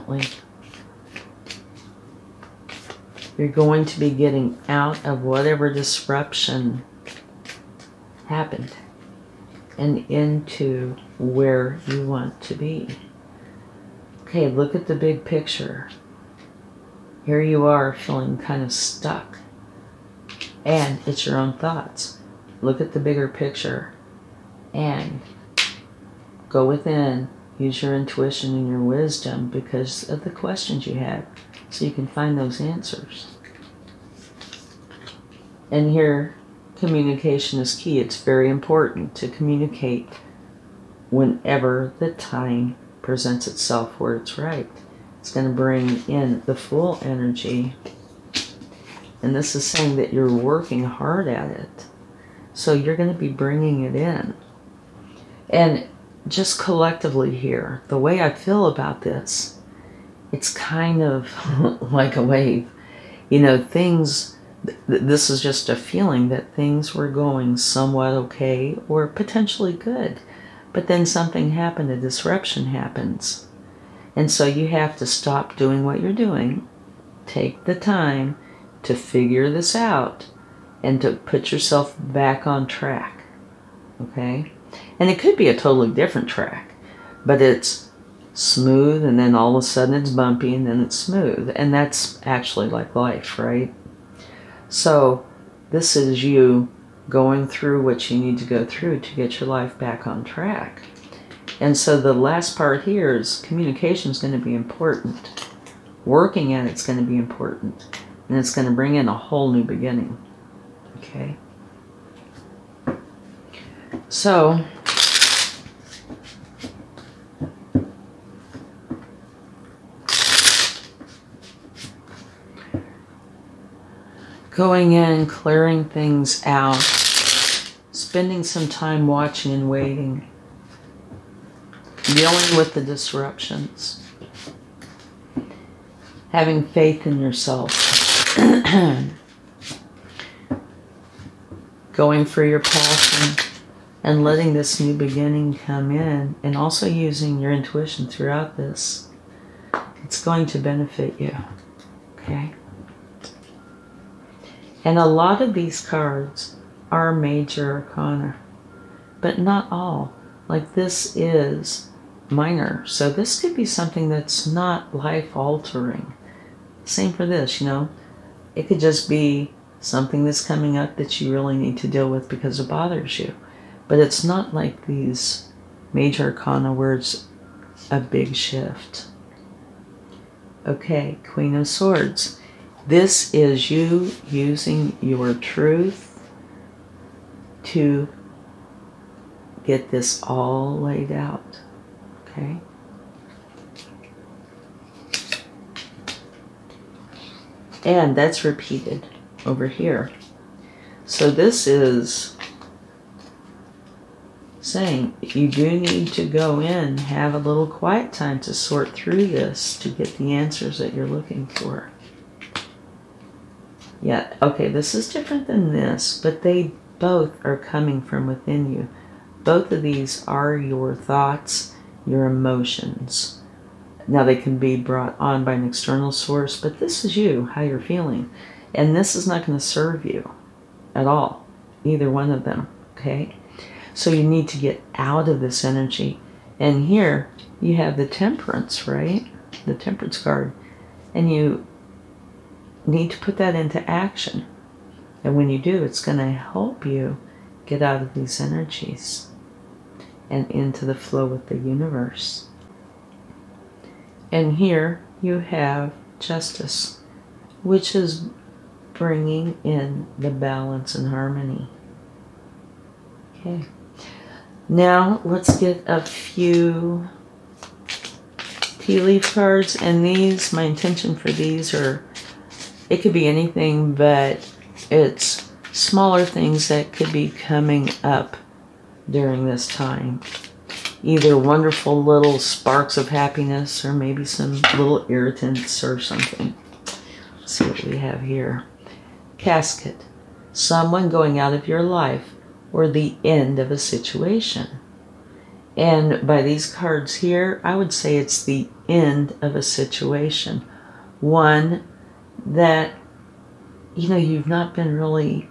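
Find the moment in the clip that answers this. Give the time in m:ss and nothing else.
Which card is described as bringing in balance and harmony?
4:16.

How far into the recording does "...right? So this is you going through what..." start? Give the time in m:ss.
1:33.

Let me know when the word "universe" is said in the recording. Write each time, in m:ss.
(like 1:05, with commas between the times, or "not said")
4:11.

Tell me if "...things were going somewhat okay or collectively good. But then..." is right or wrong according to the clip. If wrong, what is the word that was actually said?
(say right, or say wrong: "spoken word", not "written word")
wrong: "potentially", not "collectively".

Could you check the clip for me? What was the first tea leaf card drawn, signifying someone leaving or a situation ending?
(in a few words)
Casket.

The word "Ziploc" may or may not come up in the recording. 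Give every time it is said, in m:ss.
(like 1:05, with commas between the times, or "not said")
not said.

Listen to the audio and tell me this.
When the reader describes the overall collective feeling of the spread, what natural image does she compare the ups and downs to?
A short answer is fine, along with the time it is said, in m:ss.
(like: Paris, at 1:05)
a wave, at 1:01.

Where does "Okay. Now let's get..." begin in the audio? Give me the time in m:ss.
4:23.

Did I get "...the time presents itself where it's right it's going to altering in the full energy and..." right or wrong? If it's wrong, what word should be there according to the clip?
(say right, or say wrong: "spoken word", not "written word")
wrong: "bring", not "altering".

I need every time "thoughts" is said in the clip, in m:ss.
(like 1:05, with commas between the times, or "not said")
0:21, 3:40.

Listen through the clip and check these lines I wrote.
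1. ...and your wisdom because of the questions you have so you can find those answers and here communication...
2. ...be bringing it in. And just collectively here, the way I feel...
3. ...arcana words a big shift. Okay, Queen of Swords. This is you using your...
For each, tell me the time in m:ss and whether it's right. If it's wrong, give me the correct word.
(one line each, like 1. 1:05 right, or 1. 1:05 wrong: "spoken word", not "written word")
1. 0:28 right
2. 0:53 right
3. 2:56 right.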